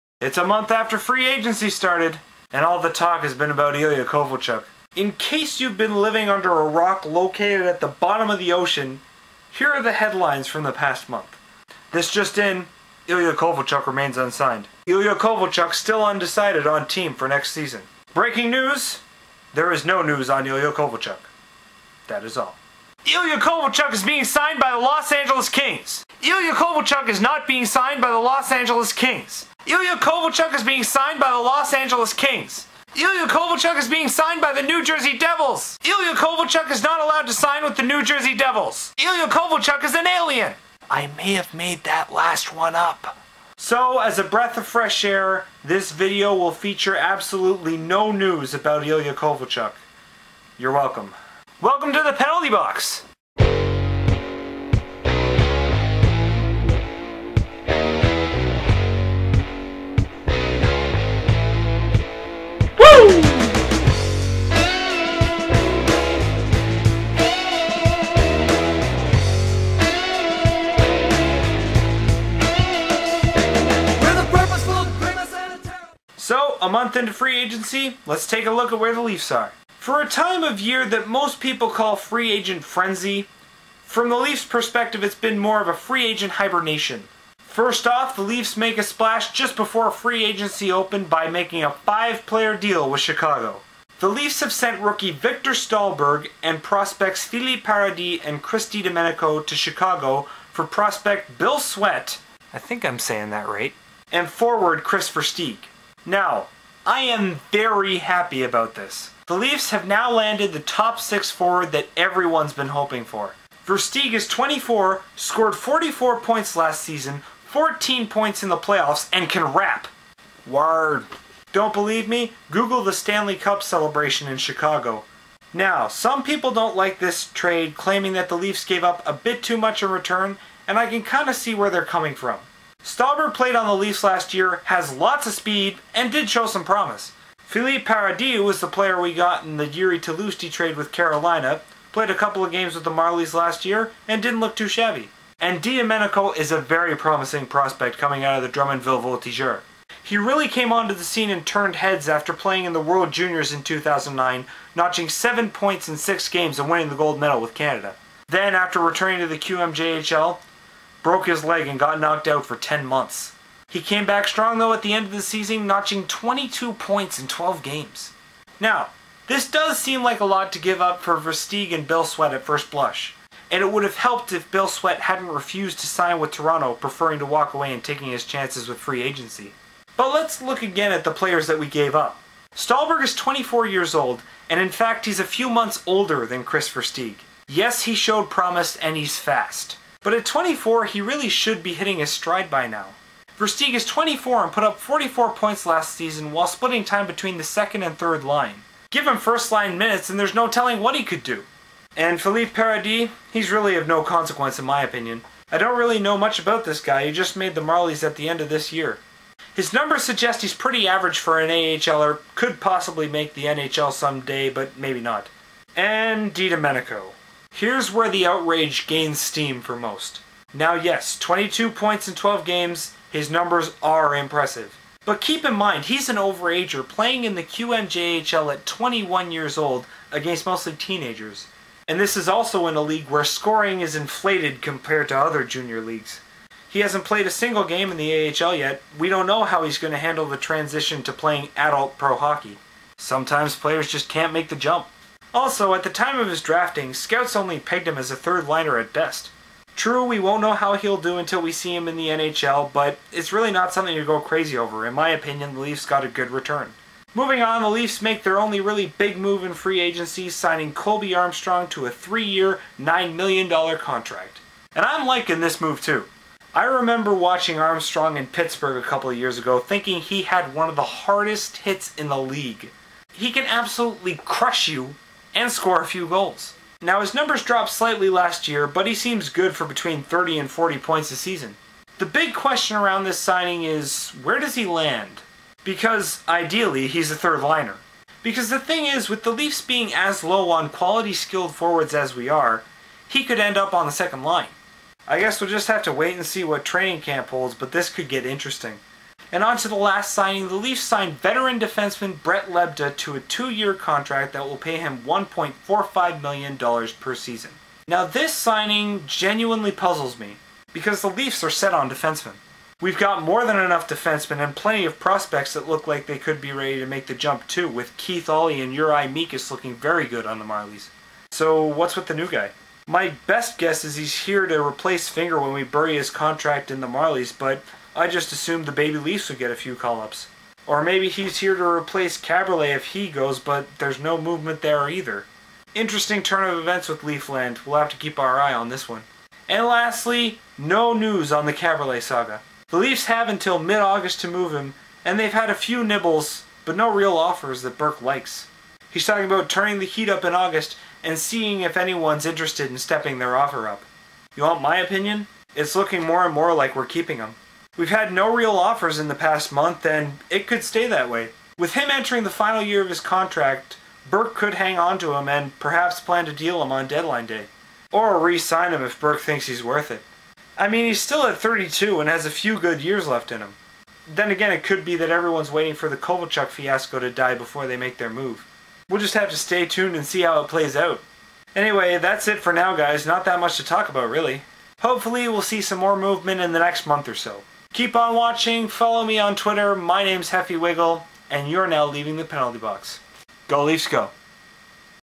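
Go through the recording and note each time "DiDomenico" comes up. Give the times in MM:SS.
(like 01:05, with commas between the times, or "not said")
01:38, 02:25, 03:36.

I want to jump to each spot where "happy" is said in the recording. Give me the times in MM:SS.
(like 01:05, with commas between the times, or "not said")
01:47.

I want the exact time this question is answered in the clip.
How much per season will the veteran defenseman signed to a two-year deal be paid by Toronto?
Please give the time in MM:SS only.
05:04.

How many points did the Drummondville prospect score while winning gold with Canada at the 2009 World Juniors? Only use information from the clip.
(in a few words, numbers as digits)
7.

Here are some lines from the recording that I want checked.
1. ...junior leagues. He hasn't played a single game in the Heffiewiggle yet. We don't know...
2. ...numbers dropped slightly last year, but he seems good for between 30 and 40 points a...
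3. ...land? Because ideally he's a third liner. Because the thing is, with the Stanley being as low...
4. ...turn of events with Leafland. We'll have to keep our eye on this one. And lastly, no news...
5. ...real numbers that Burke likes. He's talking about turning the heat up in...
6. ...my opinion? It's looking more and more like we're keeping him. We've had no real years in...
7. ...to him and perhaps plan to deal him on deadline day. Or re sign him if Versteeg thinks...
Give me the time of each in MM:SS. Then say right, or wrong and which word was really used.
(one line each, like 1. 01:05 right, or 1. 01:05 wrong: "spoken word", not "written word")
1. 03:55 wrong: "AHL", not "Heffiewiggle"
2. 04:37 right
3. 04:44 wrong: "Leafs", not "Stanley"
4. 05:36 right
5. 05:46 wrong: "offers", not "numbers"
6. 05:54 wrong: "offers", not "years"
7. 06:04 wrong: "Burke", not "Versteeg".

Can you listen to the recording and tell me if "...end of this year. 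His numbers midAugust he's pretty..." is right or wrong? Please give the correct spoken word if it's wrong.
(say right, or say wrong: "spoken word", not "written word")
wrong: "suggest", not "midAugust".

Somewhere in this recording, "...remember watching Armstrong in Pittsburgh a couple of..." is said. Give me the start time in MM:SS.
04:26.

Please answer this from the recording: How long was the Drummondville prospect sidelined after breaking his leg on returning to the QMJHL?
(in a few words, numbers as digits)
10 months.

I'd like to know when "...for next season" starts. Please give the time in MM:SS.
00:17.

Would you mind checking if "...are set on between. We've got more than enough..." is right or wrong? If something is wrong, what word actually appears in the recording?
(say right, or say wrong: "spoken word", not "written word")
wrong: "defensemen", not "between".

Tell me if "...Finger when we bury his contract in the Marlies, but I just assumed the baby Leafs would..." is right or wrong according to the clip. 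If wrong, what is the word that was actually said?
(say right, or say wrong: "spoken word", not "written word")
right.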